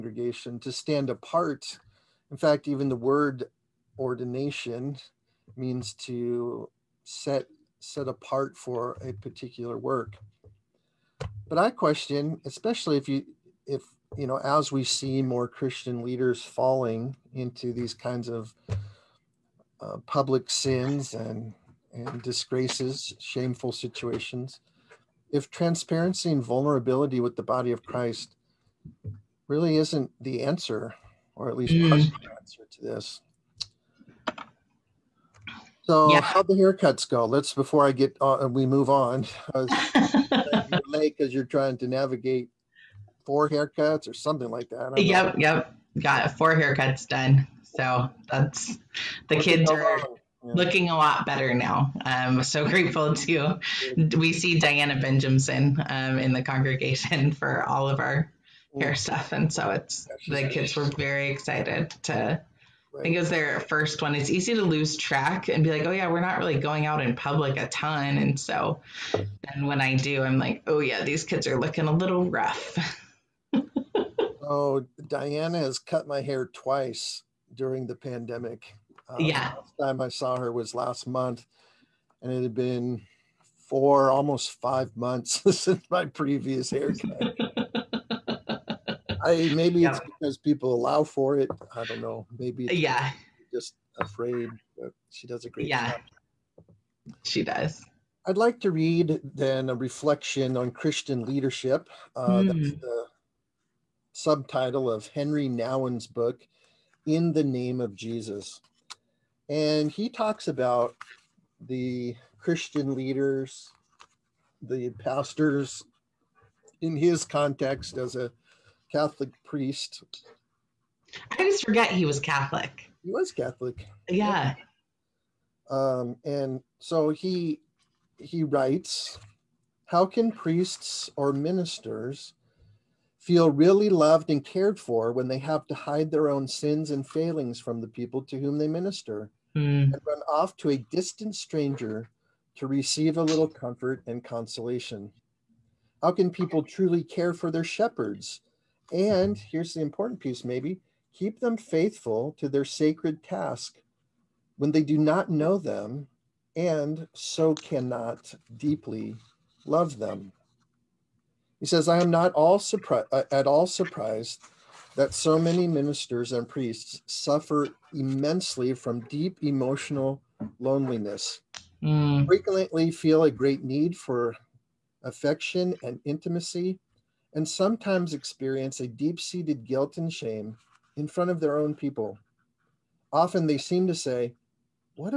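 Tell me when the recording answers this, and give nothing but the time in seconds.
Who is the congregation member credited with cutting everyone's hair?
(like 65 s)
54 s.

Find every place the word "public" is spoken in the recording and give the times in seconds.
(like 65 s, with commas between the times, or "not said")
20 s, 67 s.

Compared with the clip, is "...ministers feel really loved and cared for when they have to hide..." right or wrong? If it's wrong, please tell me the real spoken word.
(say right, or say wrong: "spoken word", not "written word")
right.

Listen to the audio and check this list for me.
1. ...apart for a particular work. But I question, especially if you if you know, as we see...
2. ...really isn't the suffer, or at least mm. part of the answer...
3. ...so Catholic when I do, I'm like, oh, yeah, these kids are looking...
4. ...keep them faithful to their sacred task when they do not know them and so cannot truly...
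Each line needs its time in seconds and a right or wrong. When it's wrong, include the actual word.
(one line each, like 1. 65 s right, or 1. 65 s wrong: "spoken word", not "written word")
1. 8 s right
2. 29 s wrong: "answer", not "suffer"
3. 68 s wrong: "And", not "Catholic"
4. 151 s wrong: "deeply", not "truly".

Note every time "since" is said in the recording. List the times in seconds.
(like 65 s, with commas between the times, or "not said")
85 s.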